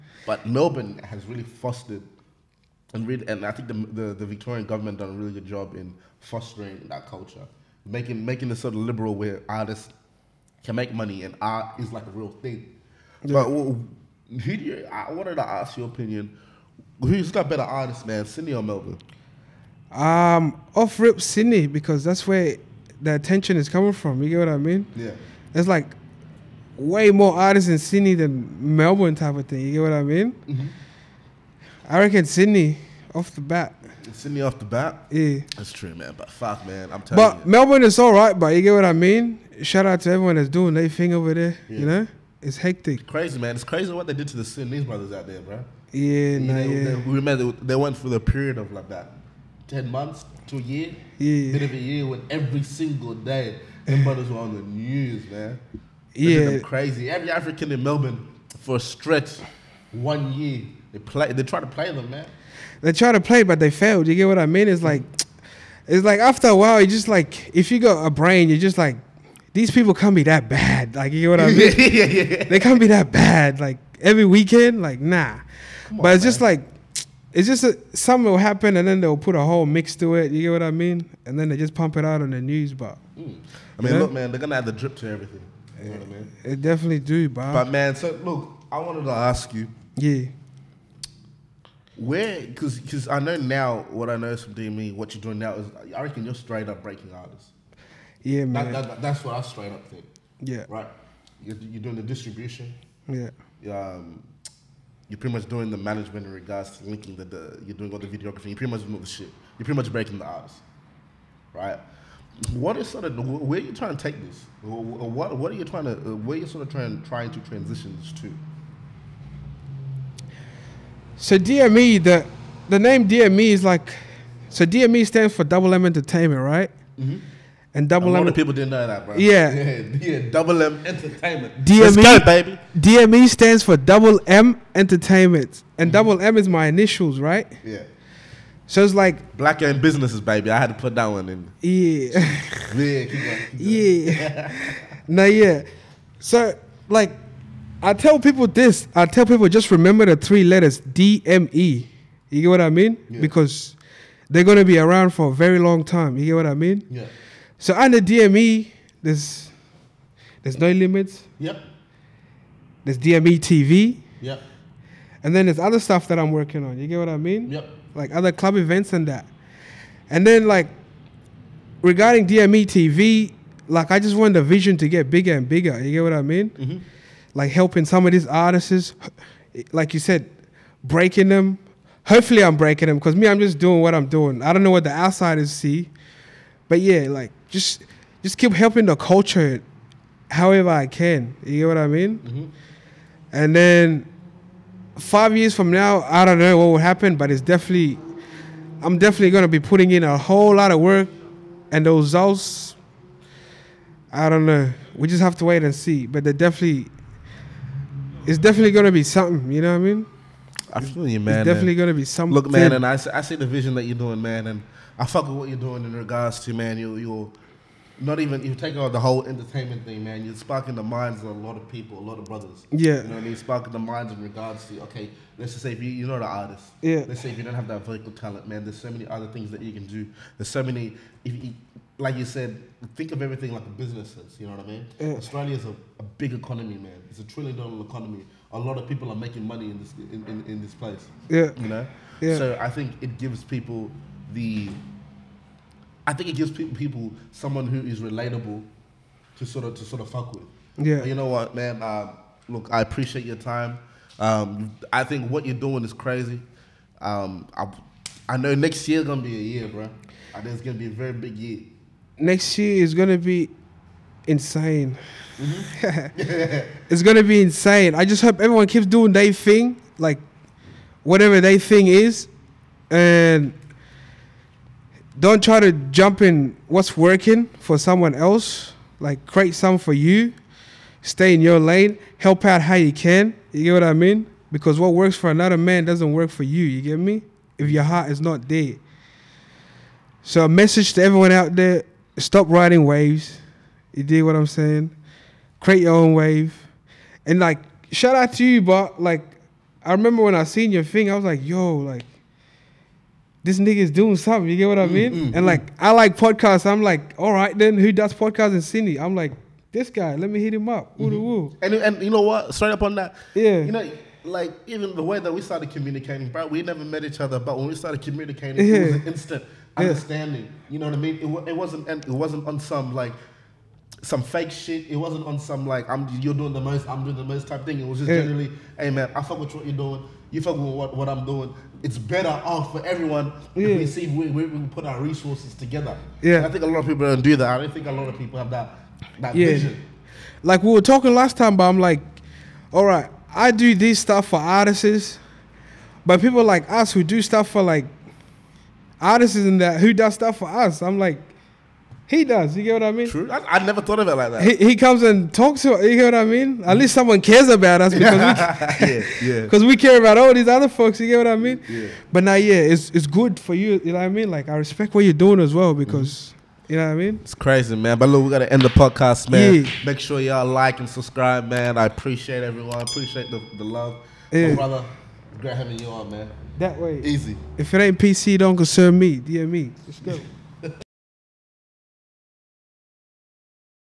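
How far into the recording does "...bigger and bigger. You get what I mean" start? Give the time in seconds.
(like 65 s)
175 s.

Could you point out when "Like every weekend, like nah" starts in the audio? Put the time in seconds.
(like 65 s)
73 s.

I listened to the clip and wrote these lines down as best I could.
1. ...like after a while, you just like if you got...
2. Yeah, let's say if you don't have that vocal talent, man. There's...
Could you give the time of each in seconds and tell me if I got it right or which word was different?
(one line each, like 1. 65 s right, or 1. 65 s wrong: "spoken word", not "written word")
1. 66 s right
2. 226 s right.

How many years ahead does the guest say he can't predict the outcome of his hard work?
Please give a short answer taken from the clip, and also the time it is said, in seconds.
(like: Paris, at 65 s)
5, at 195 s.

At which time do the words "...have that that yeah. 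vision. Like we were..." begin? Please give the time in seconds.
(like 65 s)
338 s.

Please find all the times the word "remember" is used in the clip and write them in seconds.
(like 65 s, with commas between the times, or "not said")
47 s, 149 s, 299 s.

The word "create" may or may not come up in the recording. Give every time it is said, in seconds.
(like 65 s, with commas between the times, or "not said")
279 s, 295 s.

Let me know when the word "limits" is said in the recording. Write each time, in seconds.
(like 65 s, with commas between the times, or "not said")
160 s.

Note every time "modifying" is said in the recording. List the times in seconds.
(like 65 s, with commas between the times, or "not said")
not said.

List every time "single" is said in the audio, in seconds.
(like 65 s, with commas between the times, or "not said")
52 s.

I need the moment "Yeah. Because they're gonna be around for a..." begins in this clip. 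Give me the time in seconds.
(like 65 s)
153 s.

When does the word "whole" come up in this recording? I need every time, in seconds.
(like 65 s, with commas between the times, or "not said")
79 s, 200 s, 219 s.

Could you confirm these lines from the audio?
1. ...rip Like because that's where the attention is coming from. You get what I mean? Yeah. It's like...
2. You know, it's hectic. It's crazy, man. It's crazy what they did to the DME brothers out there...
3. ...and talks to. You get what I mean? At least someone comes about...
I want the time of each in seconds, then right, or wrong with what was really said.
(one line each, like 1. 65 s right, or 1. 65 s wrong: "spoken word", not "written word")
1. 21 s wrong: "Sydney", not "Like"
2. 41 s wrong: "Sudanese", not "DME"
3. 355 s wrong: "cares", not "comes".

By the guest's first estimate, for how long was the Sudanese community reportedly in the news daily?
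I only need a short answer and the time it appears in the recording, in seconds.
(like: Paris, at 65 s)
10 months to a year, at 49 s.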